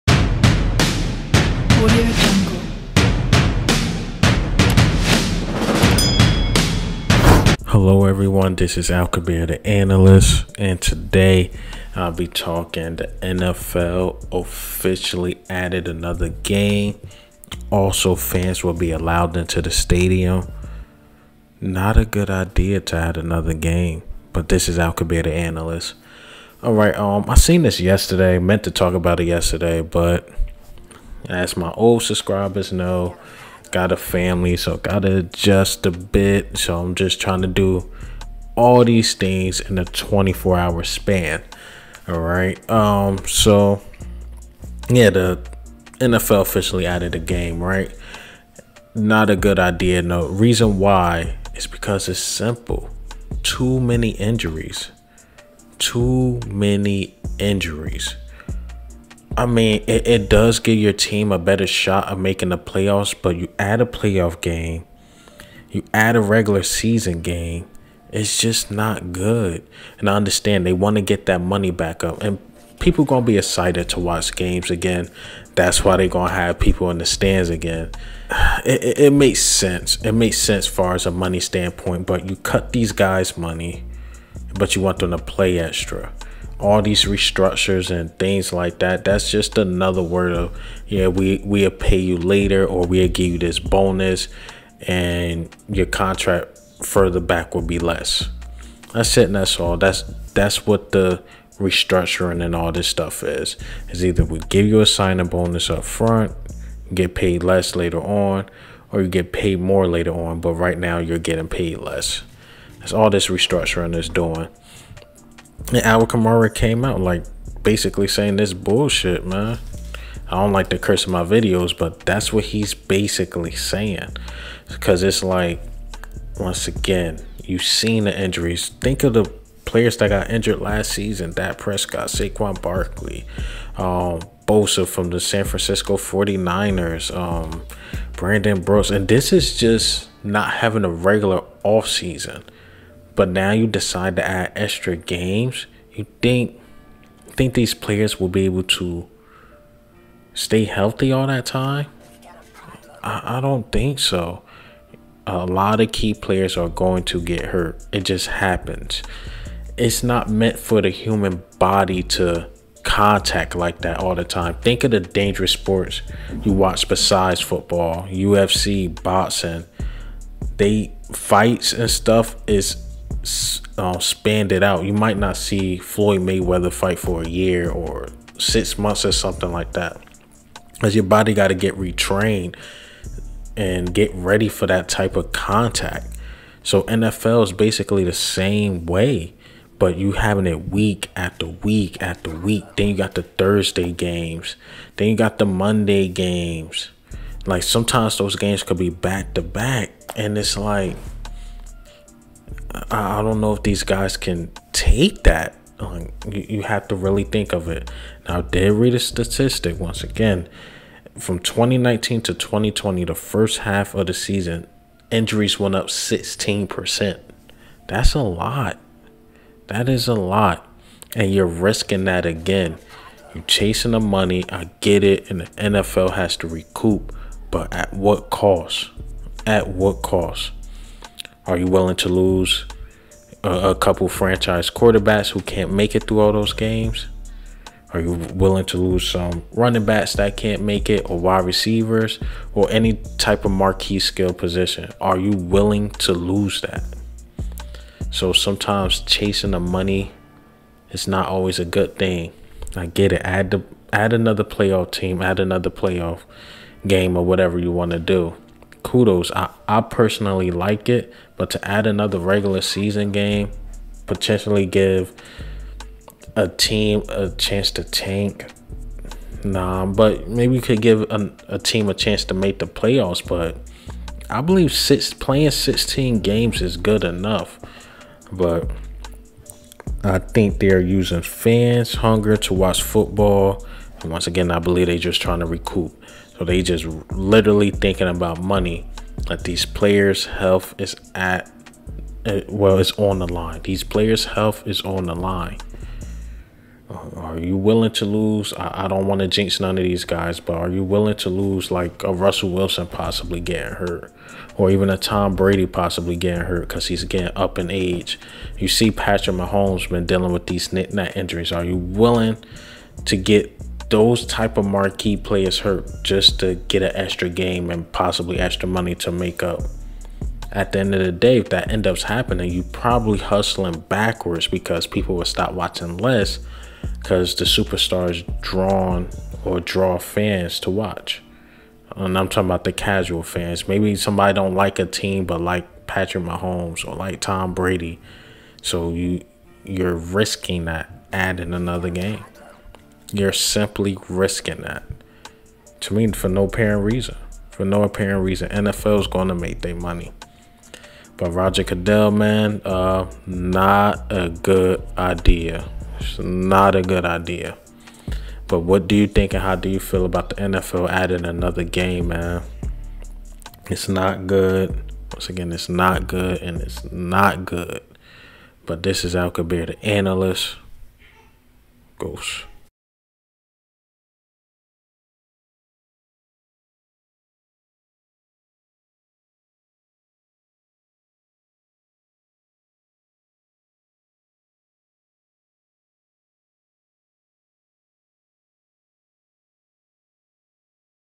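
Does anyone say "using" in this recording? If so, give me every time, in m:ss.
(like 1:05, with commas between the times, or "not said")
4:40.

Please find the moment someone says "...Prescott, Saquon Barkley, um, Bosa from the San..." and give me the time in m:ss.
2:11.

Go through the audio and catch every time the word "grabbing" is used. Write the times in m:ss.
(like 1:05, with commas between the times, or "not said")
not said.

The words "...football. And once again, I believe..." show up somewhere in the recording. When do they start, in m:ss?
4:42.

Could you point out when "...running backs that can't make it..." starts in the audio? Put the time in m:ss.
3:59.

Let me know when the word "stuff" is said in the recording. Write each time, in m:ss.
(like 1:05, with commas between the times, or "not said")
1:42, 2:51.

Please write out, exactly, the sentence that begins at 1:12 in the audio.
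And people gonna be excited to watch games again.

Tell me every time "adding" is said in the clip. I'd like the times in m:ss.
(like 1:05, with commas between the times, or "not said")
5:41, 6:00.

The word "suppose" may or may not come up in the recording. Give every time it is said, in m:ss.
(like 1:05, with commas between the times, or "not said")
not said.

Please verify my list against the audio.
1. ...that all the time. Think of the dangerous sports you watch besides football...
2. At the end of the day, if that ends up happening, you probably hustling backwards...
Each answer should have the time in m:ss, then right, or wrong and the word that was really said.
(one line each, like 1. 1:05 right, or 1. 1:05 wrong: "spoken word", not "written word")
1. 2:43 right
2. 5:20 right.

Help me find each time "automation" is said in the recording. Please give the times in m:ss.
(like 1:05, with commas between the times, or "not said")
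not said.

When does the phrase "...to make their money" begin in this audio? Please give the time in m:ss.
5:49.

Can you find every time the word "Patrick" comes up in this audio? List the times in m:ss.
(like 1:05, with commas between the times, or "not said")
5:08, 5:35.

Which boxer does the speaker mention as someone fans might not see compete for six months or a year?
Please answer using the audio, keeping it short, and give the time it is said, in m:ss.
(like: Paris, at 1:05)
Floyd Mayweather, at 2:55.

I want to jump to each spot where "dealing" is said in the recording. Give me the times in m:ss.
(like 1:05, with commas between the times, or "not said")
5:10.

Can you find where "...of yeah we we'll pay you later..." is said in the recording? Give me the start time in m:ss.
1:30.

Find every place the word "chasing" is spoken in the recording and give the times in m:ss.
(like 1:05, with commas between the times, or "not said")
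3:43, 4:09.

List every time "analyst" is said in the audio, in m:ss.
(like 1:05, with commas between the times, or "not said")
0:09, 0:25, 6:09.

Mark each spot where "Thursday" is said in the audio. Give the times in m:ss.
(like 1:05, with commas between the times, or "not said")
3:13.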